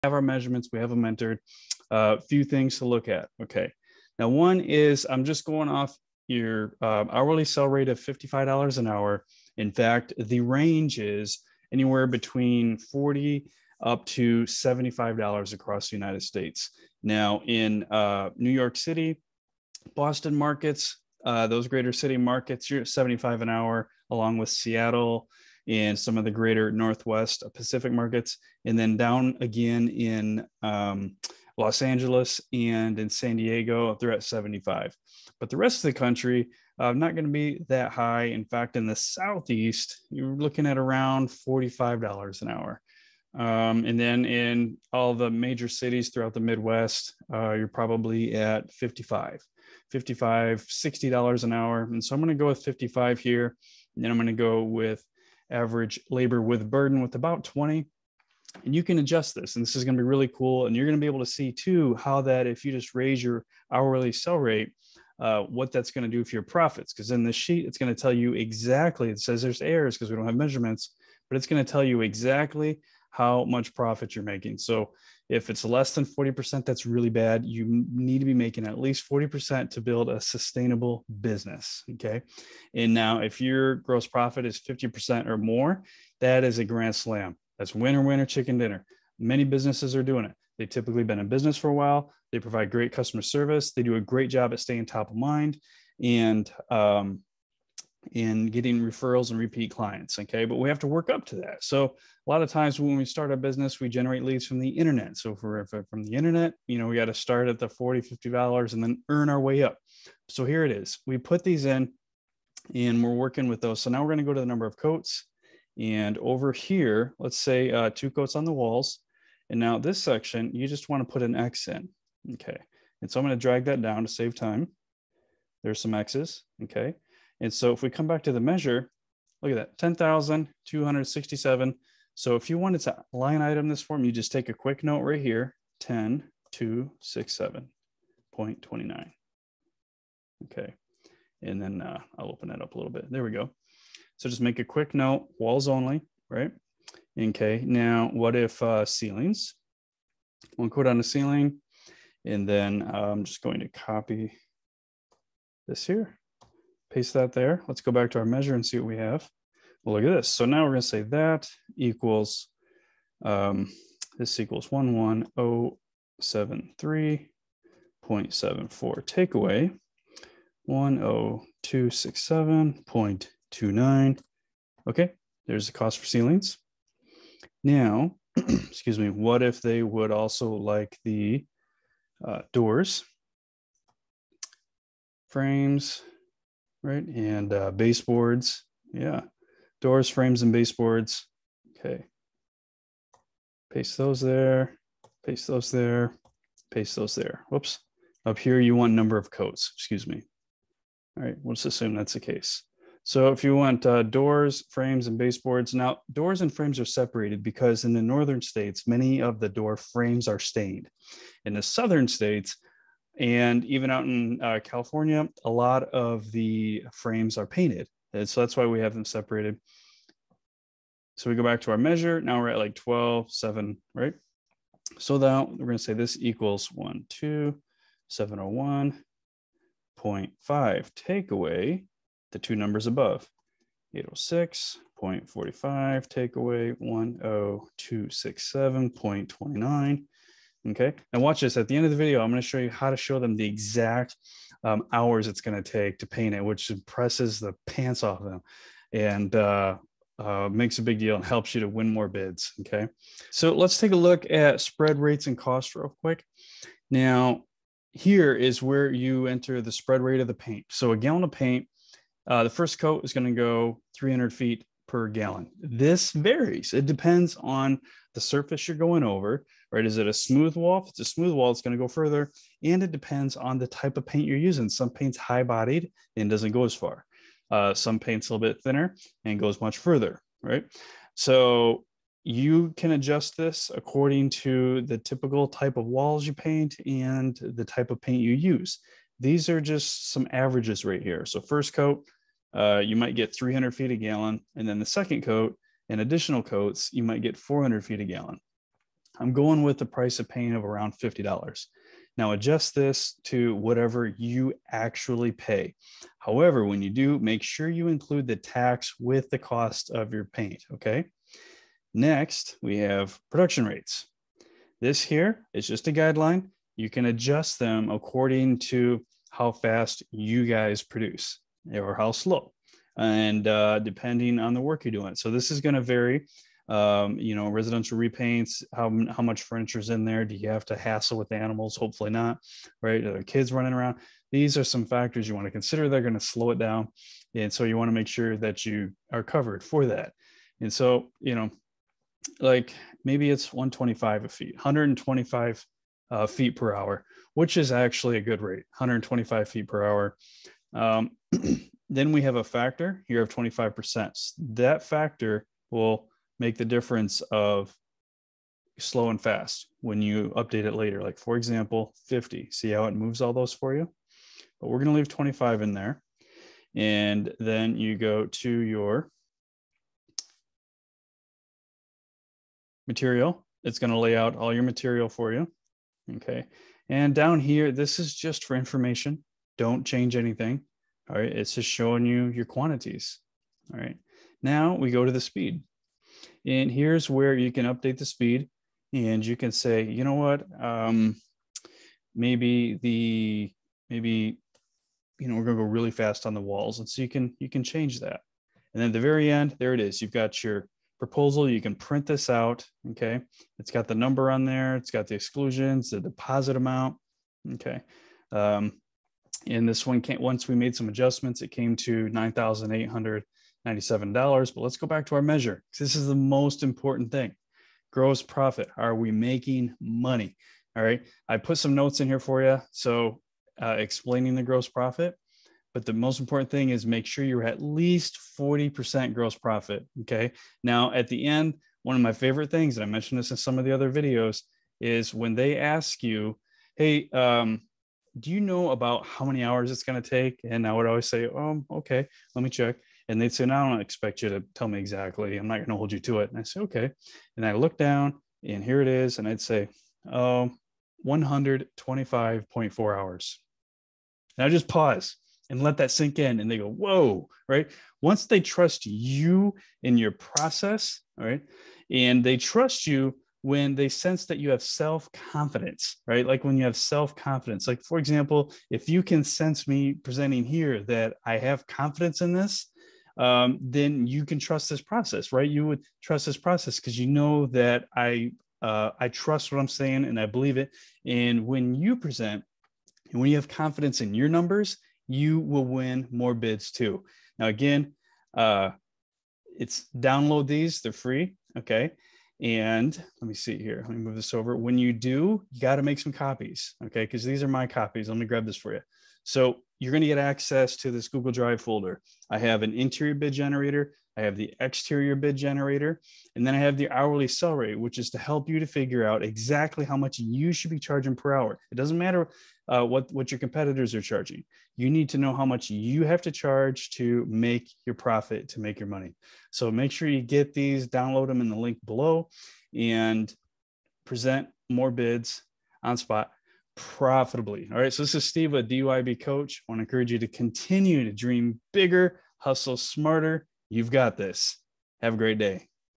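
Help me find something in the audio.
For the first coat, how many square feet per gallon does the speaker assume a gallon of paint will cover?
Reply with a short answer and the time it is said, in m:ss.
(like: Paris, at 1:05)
300, at 4:23.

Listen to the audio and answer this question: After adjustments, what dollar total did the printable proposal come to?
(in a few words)
$9,897.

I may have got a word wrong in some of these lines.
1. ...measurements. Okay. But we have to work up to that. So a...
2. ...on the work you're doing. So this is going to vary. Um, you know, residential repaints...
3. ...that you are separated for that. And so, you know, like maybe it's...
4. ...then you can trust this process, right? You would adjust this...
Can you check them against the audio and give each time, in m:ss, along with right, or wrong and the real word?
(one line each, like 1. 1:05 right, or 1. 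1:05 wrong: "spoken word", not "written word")
1. 1:39 wrong: "clients", not "measurements"
2. 5:24 right
3. 5:38 wrong: "covered", not "separated"
4. 7:53 wrong: "trust", not "adjust".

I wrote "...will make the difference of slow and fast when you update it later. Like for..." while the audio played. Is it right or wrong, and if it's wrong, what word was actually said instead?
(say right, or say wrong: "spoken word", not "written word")
right.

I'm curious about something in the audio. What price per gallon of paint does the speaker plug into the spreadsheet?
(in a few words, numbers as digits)
$50.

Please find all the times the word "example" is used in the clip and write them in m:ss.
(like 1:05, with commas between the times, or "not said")
6:01, 7:47.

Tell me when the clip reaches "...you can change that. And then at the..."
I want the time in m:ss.
6:37.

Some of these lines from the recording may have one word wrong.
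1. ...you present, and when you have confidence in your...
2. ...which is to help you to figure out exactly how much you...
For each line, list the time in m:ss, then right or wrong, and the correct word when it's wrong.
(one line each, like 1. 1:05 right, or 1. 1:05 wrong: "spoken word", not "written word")
1. 8:01 right
2. 8:27 right.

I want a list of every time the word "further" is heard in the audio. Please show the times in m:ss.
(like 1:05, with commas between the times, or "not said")
4:31, 4:39.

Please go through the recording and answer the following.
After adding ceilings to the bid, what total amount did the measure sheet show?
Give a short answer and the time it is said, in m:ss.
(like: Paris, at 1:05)
11073.74, at 2:44.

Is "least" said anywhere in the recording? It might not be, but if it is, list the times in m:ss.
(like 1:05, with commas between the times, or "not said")
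1:18, 7:07.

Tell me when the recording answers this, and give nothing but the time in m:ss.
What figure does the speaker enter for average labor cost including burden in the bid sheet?
0:57.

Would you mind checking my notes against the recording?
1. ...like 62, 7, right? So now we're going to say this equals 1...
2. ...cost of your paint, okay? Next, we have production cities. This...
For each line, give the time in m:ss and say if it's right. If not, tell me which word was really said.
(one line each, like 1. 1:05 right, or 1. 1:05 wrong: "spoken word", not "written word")
1. 3:42 wrong: "12", not "62"
2. 5:09 wrong: "rates", not "cities".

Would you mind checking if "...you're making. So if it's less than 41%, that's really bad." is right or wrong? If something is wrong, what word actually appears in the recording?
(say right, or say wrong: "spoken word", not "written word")
wrong: "40", not "41".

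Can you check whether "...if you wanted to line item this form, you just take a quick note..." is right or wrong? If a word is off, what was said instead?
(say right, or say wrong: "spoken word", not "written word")
right.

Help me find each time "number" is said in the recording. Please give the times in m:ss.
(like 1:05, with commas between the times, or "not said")
1:54, 3:18, 3:52, 6:43, 8:04.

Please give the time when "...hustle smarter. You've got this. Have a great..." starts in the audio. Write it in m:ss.
8:52.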